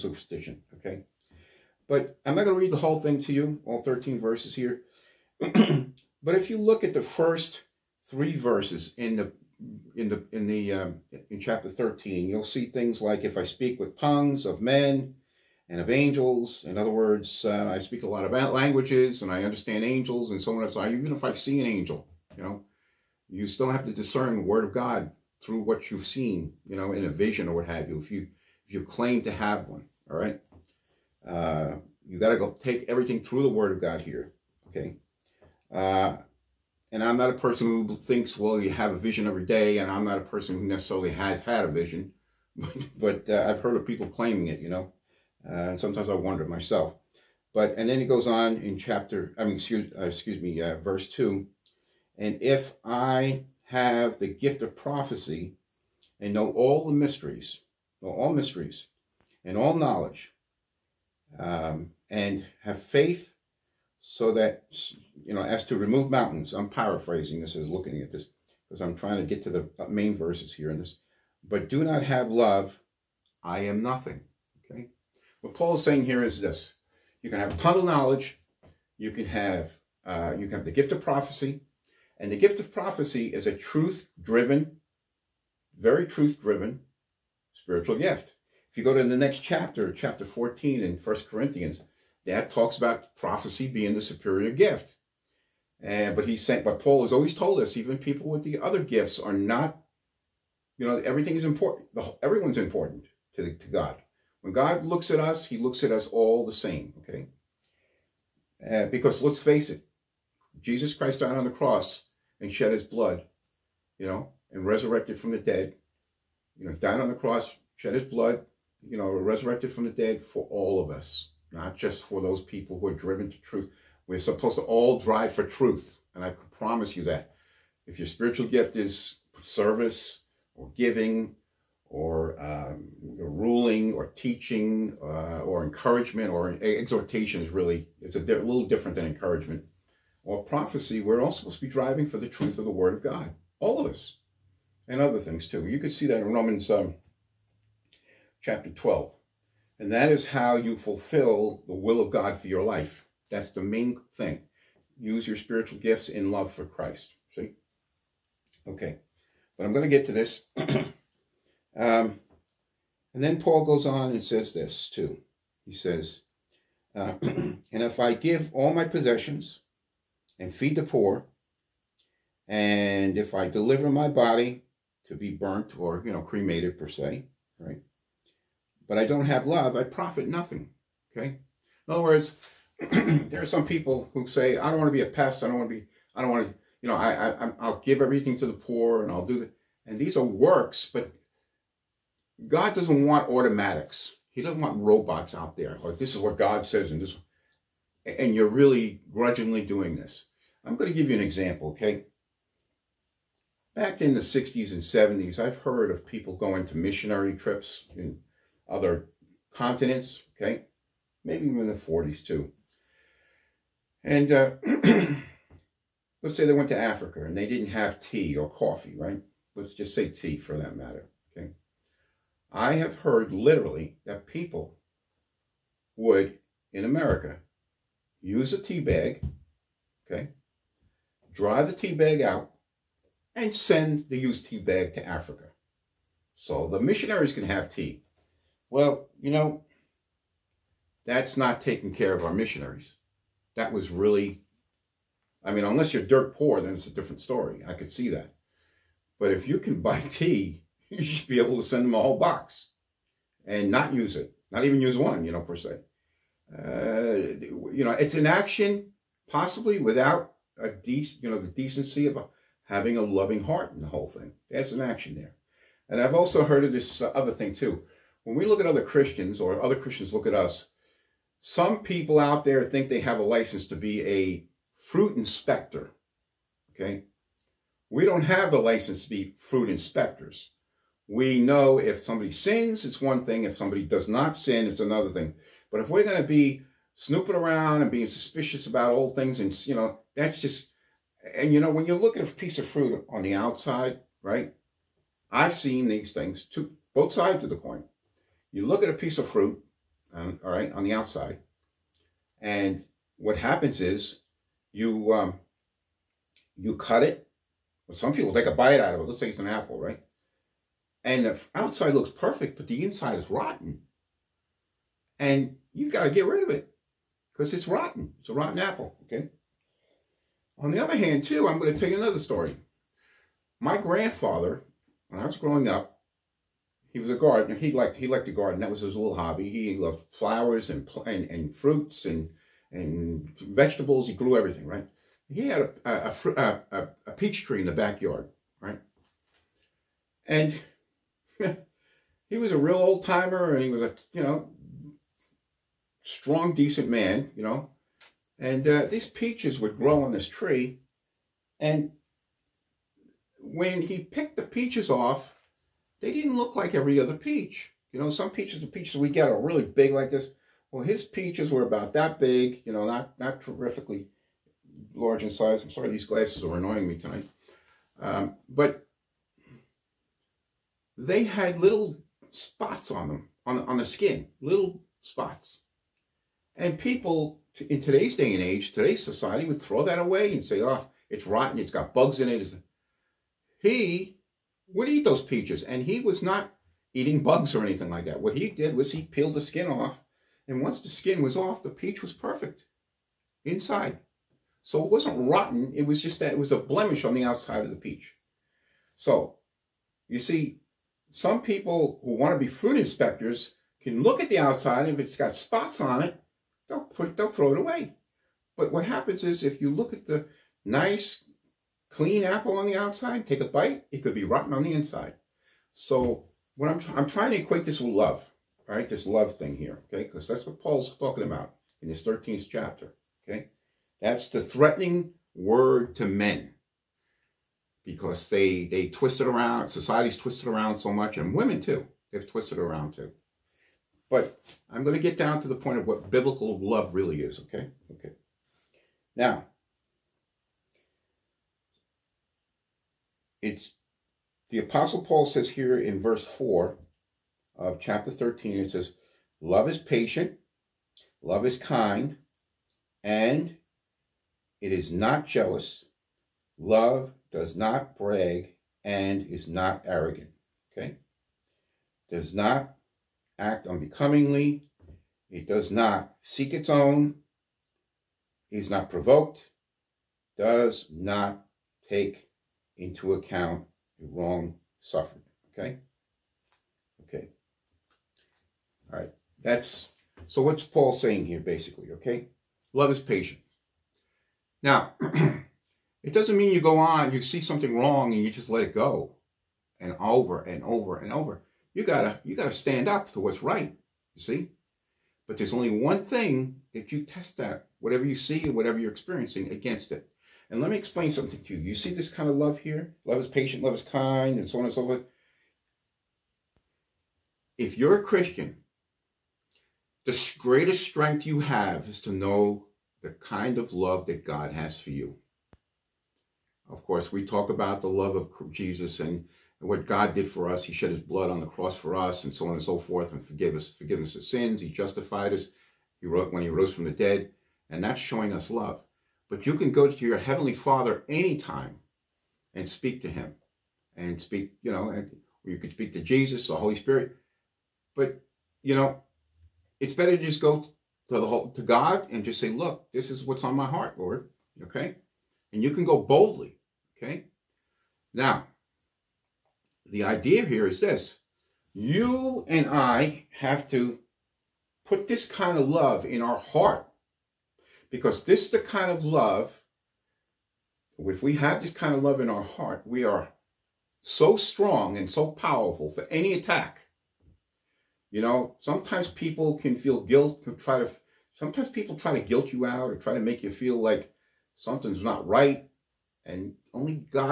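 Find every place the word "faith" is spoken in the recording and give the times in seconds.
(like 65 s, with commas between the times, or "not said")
62 s.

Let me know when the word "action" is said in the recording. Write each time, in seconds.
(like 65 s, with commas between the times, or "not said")
258 s, 264 s.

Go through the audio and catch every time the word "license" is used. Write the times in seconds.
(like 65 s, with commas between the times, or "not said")
273 s, 278 s.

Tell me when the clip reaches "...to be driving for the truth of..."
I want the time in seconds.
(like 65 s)
141 s.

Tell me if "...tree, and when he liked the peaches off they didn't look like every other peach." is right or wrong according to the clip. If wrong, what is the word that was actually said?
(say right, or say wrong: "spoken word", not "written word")
wrong: "picked", not "liked".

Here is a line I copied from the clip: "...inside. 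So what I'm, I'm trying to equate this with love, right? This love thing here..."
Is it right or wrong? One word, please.
right.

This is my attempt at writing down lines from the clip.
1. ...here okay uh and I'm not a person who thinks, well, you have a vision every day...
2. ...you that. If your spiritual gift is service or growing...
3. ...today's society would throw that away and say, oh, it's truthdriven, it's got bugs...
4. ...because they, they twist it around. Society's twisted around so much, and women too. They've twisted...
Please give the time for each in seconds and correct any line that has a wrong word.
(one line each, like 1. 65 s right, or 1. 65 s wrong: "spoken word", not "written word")
1. 34 s right
2. 126 s wrong: "giving", not "growing"
3. 378 s wrong: "rotten", not "truthdriven"
4. 427 s right.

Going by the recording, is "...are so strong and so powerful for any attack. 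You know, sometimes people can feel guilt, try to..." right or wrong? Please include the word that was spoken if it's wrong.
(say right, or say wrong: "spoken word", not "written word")
right.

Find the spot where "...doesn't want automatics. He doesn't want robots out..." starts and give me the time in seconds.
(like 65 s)
192 s.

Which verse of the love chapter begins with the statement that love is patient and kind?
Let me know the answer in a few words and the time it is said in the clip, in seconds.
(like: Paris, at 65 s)
Verse 4, at 446 s.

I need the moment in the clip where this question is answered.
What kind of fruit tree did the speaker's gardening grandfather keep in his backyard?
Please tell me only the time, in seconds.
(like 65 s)
337 s.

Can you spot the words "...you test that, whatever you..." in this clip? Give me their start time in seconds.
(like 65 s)
496 s.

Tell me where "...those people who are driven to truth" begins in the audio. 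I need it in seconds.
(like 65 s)
122 s.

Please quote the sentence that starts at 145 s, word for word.
You could see that in Romans um, chapter 12.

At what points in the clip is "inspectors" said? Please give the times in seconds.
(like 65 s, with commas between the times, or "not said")
275 s, 279 s, 402 s.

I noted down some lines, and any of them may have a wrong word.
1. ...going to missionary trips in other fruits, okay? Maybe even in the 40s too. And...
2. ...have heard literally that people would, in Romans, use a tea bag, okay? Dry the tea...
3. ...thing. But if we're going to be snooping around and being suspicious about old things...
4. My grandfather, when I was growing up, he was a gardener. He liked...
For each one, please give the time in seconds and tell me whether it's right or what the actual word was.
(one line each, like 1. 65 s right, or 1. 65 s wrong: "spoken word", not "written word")
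1. 206 s wrong: "continents", not "fruits"
2. 222 s wrong: "America", not "Romans"
3. 285 s right
4. 323 s right.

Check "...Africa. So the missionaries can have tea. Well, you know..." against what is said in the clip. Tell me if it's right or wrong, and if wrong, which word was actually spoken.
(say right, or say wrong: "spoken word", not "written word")
right.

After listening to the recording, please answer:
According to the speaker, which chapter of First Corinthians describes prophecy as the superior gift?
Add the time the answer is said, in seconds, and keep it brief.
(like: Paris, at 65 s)
Chapter 14, at 89 s.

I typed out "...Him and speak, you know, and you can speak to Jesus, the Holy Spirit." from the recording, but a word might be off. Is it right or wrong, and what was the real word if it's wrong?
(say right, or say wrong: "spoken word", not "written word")
right.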